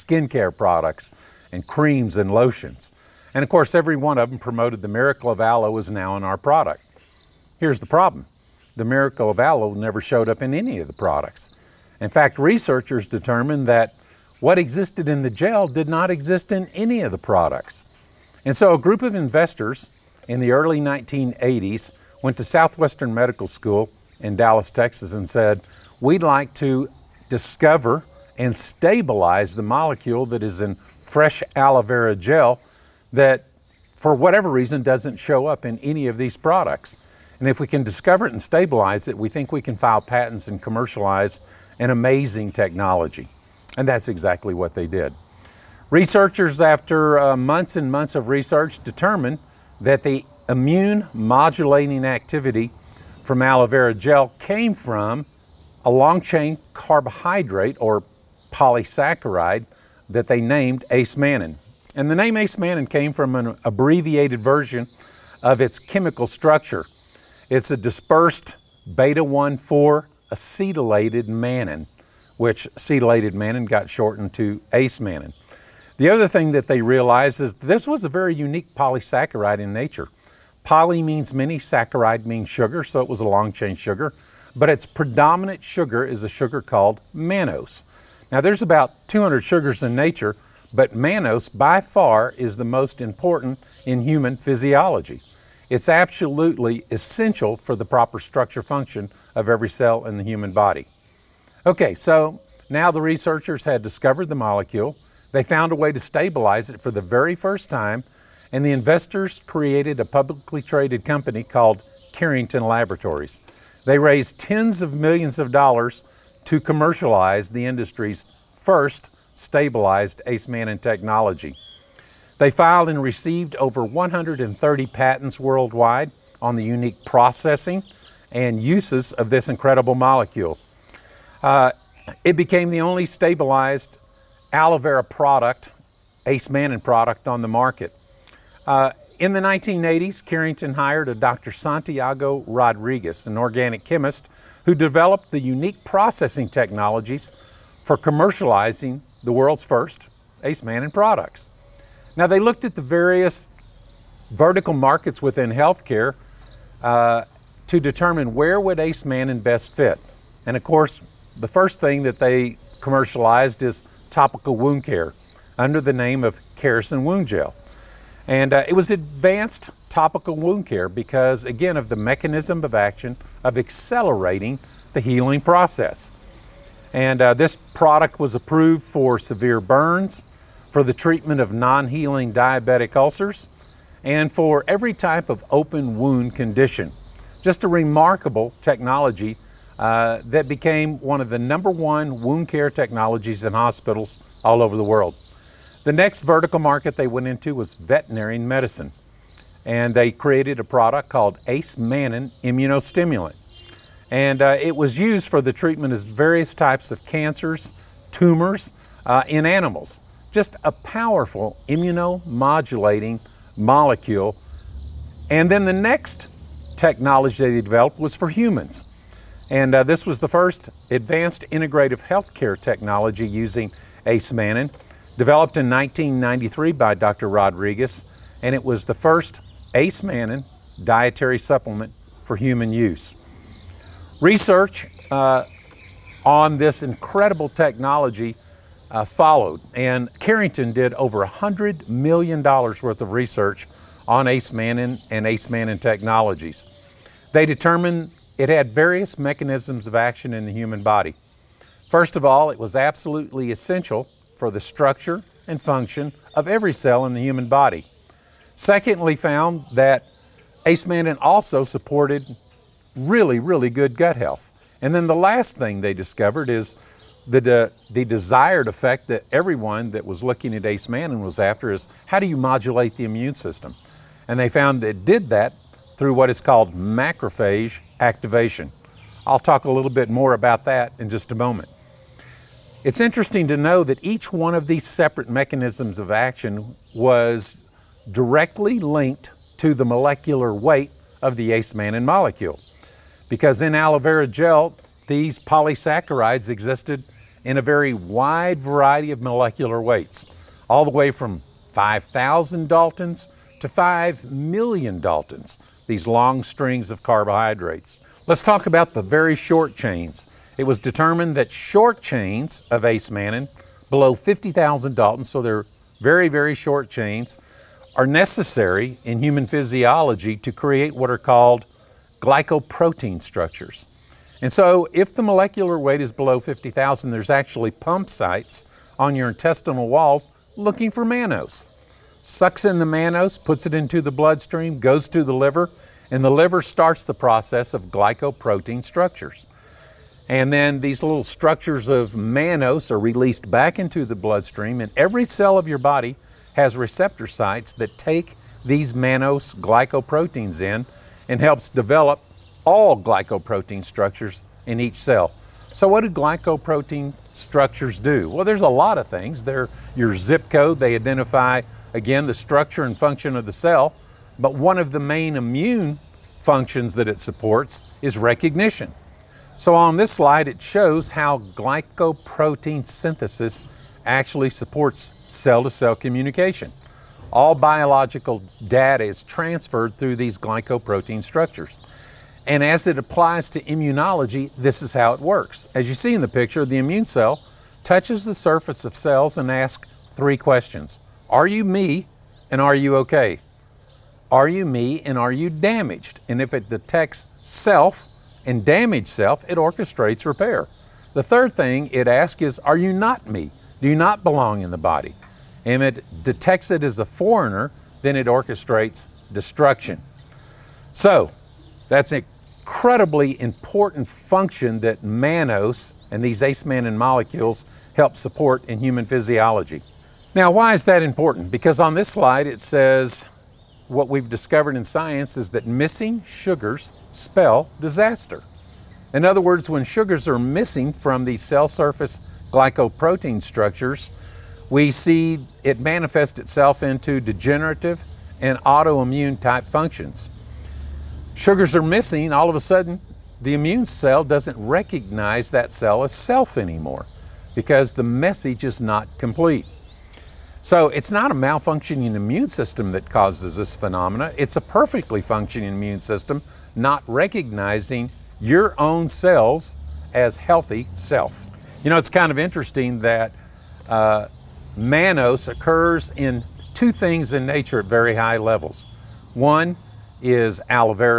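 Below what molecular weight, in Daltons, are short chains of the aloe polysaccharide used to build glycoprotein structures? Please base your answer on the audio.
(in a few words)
50,000 Daltons.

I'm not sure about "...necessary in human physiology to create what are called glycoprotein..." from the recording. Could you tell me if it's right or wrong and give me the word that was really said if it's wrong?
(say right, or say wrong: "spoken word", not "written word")
right.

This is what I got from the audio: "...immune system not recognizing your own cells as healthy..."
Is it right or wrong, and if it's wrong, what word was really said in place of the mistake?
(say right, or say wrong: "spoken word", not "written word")
right.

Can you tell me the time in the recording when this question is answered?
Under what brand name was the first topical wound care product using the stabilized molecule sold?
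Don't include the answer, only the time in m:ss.
2:46.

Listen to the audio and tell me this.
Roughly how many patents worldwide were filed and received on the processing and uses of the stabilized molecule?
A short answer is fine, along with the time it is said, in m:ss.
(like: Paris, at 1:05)
over 130, at 2:03.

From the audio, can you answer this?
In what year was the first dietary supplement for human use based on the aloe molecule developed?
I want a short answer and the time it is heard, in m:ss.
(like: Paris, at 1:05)
1993, at 3:45.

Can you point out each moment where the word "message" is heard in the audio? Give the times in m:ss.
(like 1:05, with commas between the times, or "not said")
7:28.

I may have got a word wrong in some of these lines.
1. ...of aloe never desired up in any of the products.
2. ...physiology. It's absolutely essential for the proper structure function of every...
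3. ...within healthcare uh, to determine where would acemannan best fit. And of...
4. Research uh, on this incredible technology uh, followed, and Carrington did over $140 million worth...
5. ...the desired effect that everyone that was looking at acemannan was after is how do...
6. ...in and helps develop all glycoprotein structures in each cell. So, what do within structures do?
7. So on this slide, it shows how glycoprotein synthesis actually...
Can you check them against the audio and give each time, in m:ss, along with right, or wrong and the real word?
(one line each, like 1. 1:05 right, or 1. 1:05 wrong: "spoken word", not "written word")
1. 0:09 wrong: "showed", not "desired"
2. 1:34 right
3. 2:35 right
4. 3:54 wrong: "100", not "140"
5. 4:27 right
6. 5:50 wrong: "glycoprotein", not "within"
7. 6:09 right.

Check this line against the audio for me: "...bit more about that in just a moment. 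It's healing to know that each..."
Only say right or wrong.
wrong.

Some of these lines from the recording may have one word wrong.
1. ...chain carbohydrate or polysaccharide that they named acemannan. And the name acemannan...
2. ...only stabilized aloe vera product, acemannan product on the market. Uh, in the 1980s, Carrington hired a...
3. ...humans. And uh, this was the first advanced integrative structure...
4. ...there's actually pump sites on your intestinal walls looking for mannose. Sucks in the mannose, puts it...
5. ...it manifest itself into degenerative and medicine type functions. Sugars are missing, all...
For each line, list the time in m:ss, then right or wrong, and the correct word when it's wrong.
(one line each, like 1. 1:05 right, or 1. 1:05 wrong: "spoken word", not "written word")
1. 0:56 right
2. 2:12 right
3. 3:38 wrong: "healthcare", not "structure"
4. 5:27 right
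5. 7:15 wrong: "autoimmune", not "medicine".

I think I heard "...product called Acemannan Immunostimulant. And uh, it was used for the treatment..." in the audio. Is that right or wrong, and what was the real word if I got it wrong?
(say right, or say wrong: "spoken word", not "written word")
right.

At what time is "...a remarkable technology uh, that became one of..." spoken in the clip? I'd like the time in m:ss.
3:07.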